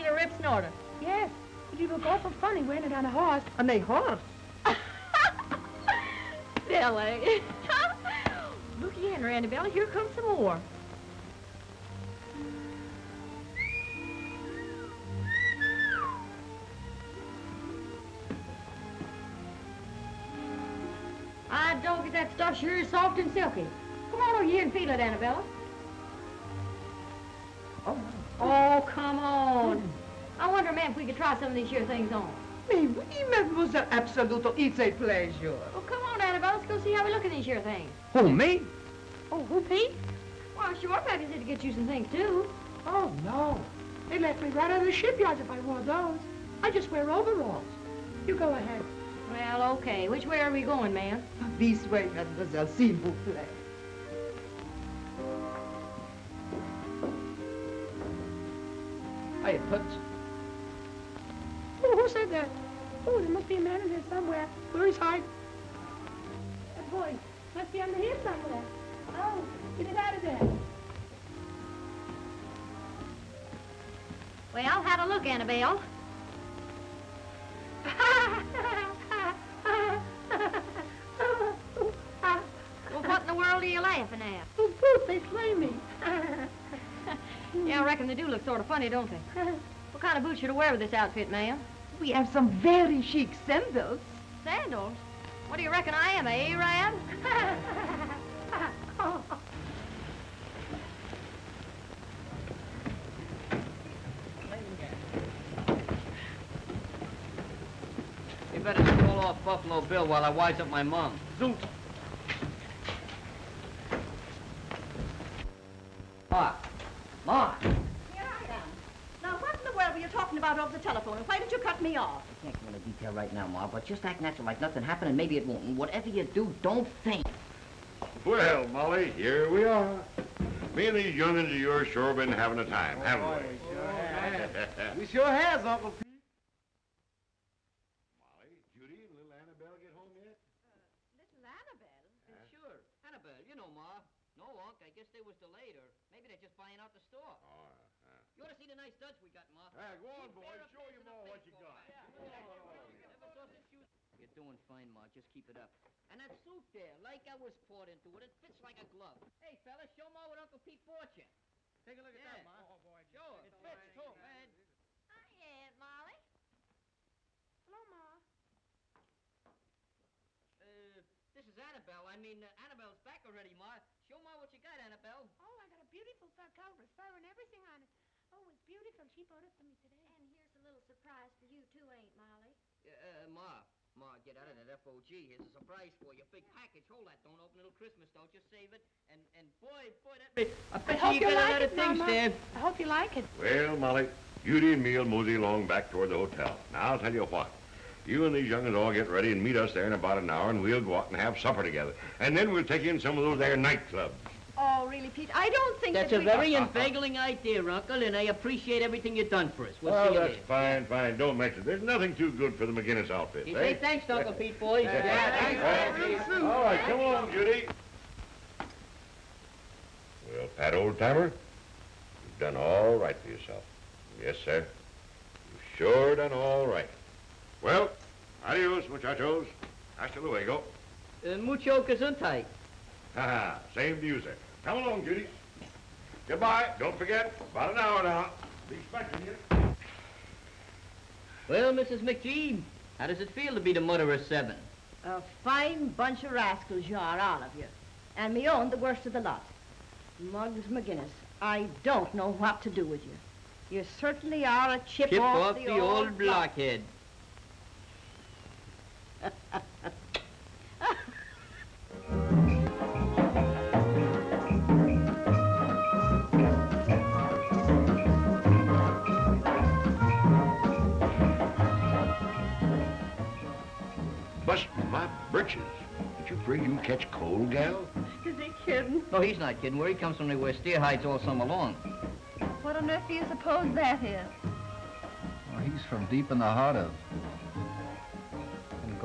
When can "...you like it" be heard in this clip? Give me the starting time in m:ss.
3:12.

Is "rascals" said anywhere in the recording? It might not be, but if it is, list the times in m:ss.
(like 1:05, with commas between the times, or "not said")
4:06.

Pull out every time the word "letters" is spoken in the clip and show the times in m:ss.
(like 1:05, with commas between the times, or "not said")
not said.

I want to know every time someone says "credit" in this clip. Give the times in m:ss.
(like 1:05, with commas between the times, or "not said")
not said.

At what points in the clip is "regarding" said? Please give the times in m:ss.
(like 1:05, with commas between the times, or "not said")
not said.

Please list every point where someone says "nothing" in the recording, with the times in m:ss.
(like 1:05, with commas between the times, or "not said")
2:04, 3:31.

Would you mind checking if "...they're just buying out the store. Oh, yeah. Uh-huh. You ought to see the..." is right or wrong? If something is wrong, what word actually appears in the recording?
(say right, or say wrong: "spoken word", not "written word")
right.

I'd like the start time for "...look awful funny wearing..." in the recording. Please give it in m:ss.
0:01.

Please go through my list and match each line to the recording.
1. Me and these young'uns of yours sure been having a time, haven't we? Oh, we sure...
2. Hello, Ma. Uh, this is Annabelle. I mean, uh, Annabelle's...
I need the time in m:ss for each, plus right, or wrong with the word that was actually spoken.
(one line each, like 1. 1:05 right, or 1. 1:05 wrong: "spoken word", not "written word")
1. 2:10 right
2. 2:47 right.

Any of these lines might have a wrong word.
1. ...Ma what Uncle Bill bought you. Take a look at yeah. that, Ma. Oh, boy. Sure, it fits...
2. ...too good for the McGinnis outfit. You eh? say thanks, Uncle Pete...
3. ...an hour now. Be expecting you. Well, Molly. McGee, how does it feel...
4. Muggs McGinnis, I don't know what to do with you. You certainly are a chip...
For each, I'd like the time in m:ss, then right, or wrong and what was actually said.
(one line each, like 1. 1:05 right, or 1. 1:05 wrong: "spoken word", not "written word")
1. 2:40 wrong: "Pete", not "Bill"
2. 3:32 right
3. 3:57 wrong: "Mrs", not "Molly"
4. 4:10 right.